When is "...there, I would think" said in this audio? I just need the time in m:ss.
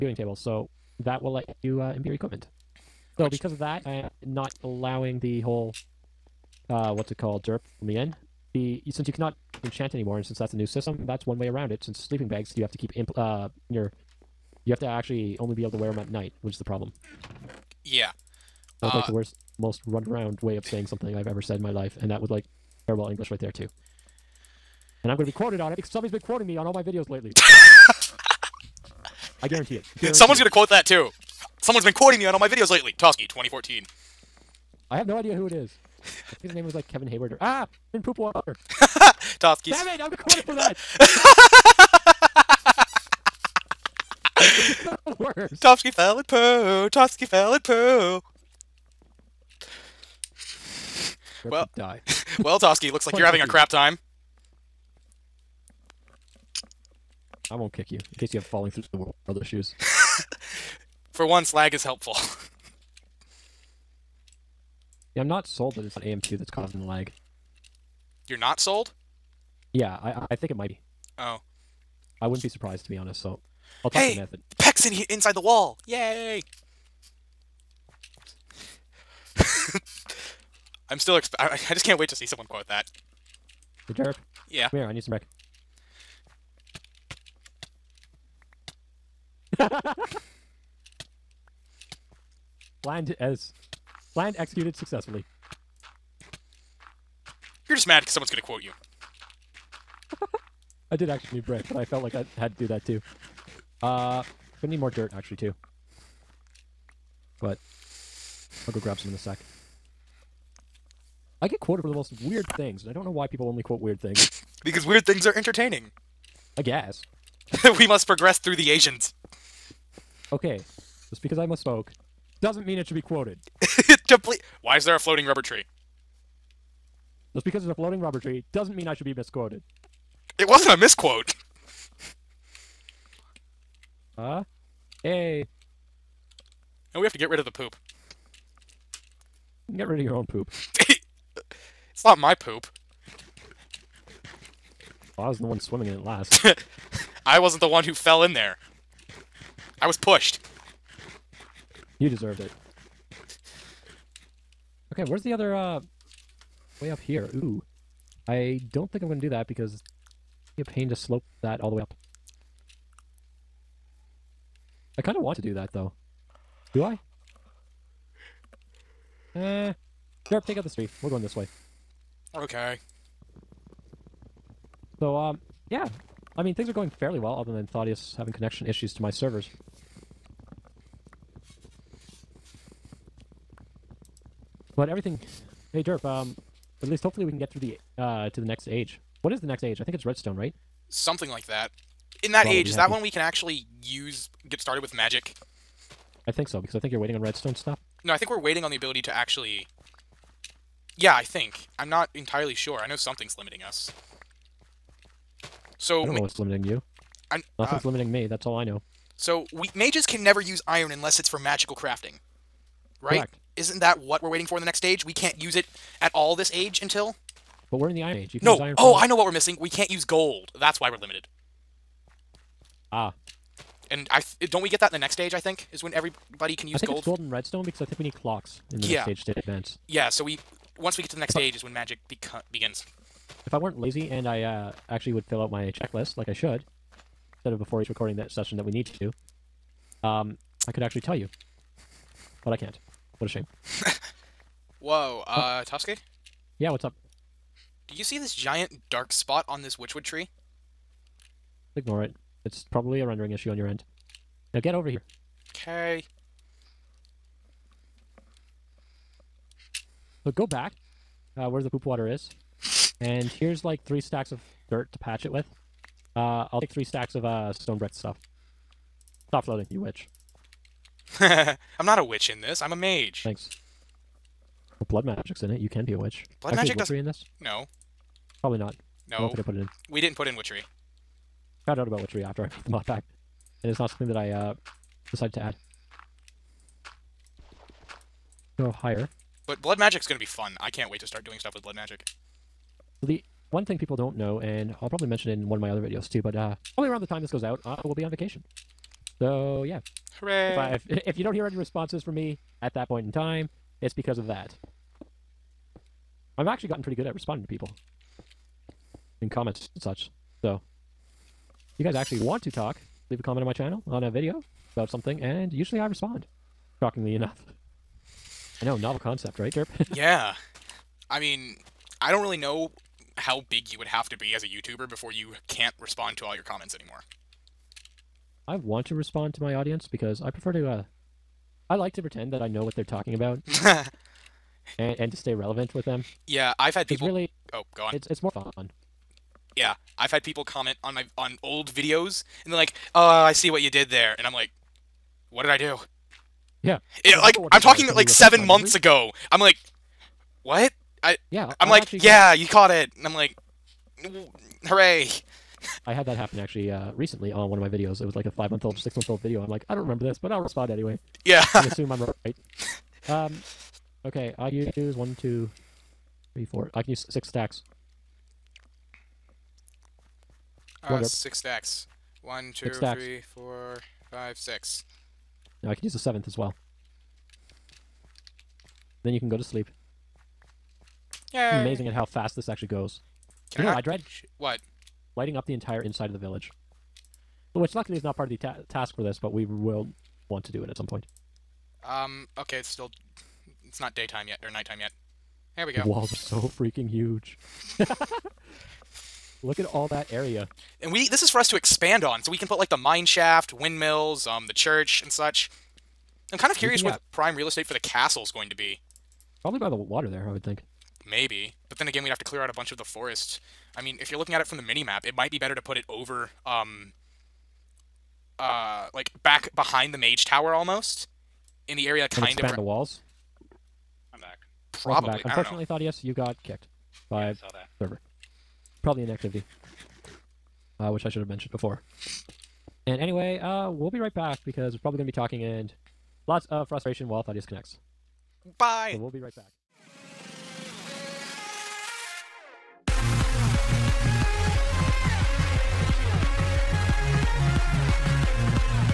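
6:50.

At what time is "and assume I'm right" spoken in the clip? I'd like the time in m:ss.
6:01.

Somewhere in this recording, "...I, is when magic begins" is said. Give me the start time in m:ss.
3:51.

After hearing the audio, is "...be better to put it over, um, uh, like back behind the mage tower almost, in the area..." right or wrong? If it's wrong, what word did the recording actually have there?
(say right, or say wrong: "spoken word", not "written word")
right.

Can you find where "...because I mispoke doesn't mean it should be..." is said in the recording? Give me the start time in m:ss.
2:01.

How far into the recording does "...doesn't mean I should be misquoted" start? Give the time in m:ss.
2:08.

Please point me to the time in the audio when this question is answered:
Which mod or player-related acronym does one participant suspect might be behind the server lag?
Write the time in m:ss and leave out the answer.
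1:06.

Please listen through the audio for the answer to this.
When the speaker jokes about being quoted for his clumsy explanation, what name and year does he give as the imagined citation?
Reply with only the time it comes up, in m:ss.
0:32.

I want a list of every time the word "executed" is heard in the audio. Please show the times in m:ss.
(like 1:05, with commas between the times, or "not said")
1:34.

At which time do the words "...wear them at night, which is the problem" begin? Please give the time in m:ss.
0:15.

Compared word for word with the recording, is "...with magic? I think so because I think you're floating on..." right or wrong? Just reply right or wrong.
wrong.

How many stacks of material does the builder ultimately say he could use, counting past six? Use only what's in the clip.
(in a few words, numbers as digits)
7.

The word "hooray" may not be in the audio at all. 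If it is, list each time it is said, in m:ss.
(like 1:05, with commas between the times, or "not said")
5:00, 5:54.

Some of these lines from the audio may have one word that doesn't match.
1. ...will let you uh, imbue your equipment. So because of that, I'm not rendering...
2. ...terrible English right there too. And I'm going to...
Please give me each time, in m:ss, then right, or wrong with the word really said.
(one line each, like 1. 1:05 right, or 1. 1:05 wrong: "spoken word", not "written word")
1. 0:01 wrong: "allowing", not "rendering"
2. 0:22 right.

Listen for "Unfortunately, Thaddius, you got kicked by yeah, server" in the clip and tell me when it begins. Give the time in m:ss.
7:05.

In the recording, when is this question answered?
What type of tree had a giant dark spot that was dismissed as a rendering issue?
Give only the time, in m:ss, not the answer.
4:09.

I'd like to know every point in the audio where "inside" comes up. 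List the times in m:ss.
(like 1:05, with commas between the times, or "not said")
1:15, 6:25.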